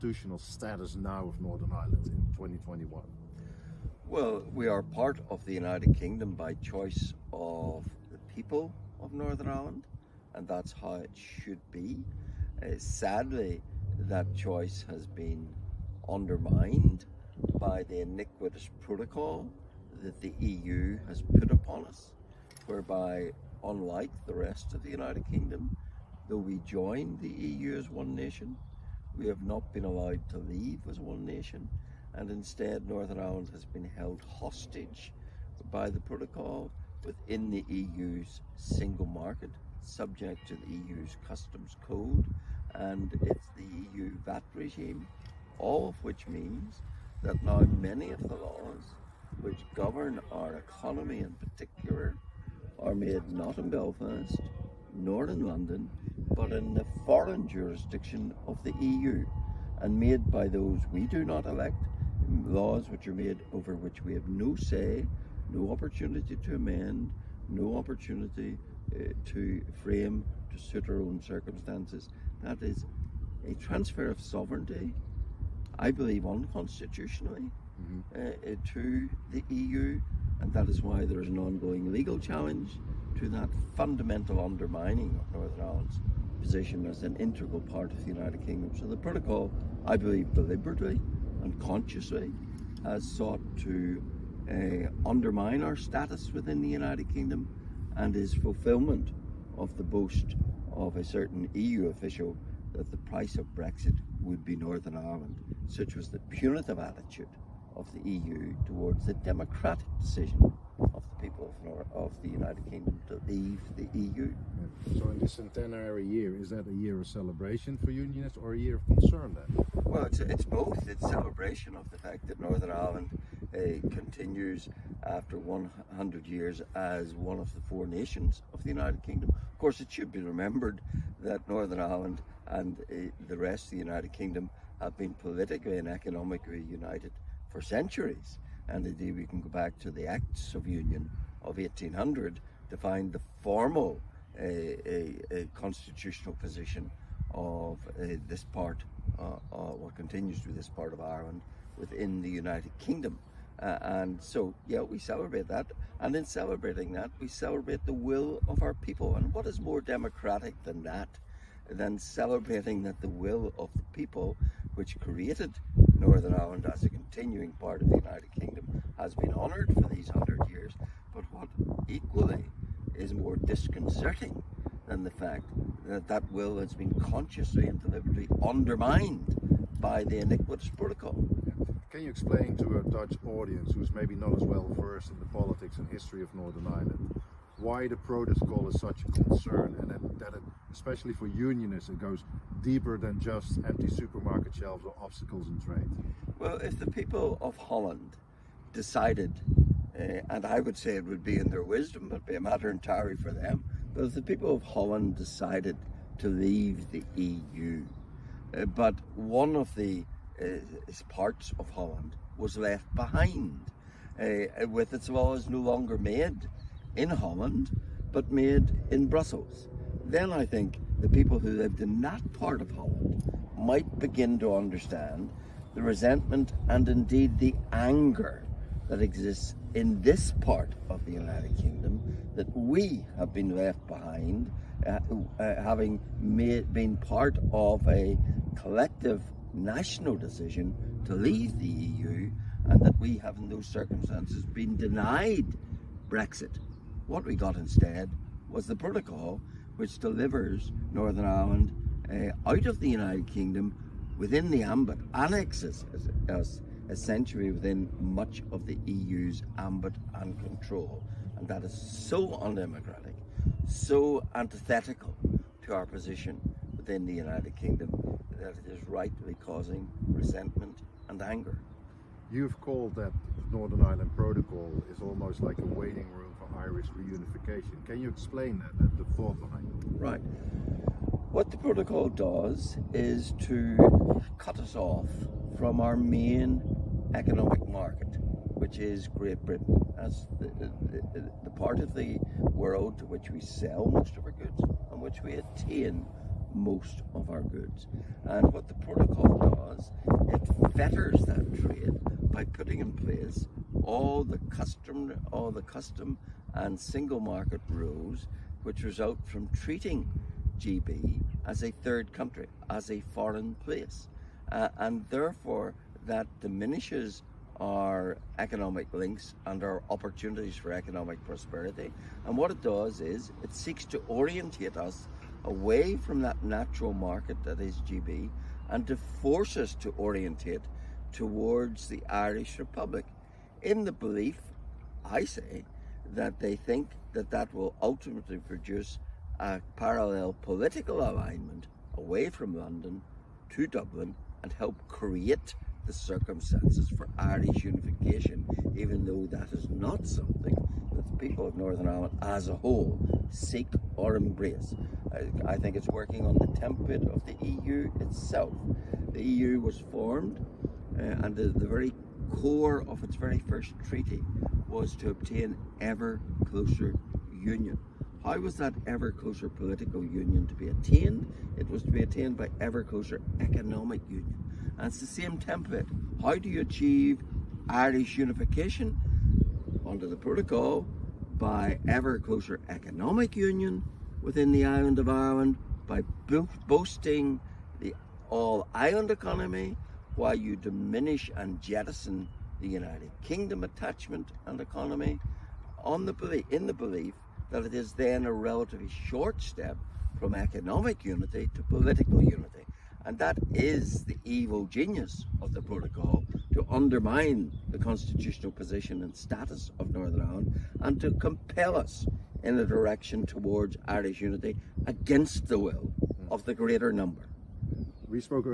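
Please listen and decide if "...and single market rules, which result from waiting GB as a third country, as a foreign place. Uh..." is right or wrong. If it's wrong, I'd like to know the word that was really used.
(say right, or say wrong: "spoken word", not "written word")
wrong: "treating", not "waiting".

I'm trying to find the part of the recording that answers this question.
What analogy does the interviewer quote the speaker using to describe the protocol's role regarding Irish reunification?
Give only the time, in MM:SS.
04:35.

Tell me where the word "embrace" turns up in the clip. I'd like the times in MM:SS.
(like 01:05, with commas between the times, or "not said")
05:54.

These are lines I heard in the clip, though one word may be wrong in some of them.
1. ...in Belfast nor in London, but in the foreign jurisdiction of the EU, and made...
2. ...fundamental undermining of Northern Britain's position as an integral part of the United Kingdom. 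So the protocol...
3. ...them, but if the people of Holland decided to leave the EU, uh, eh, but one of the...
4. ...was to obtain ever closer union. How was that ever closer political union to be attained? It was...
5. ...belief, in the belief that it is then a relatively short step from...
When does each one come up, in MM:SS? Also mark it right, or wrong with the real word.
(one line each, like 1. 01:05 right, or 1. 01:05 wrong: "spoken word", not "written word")
1. 00:53 right
2. 01:23 wrong: "Ireland", not "Britain"
3. 03:23 right
4. 06:04 right
5. 06:36 right.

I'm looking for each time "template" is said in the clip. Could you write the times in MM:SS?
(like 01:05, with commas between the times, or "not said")
05:56, 06:15.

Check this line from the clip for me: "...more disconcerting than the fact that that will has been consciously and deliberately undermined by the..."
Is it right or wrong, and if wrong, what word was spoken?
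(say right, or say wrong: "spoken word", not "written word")
right.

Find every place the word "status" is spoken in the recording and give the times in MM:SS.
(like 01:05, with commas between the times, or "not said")
00:00, 01:35, 06:49.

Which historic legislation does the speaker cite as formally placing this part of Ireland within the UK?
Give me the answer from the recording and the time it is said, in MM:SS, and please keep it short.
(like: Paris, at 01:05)
Acts of Union of 1800, at 02:20.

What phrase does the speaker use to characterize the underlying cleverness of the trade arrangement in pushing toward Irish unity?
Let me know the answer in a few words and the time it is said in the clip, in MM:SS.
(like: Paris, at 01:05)
evil genius, at 06:44.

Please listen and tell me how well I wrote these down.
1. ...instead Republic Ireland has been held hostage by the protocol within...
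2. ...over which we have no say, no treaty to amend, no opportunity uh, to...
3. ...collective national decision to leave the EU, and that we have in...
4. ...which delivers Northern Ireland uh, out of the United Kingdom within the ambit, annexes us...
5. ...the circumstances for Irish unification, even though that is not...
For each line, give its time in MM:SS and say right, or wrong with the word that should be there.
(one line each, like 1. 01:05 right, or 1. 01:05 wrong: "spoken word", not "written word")
1. 00:32 wrong: "Northern", not "Republic"
2. 01:03 wrong: "opportunity", not "treaty"
3. 03:58 right
4. 04:09 right
5. 05:45 right.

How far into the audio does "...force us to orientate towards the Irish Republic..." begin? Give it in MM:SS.
05:28.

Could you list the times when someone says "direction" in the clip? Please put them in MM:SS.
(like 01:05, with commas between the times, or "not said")
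06:52.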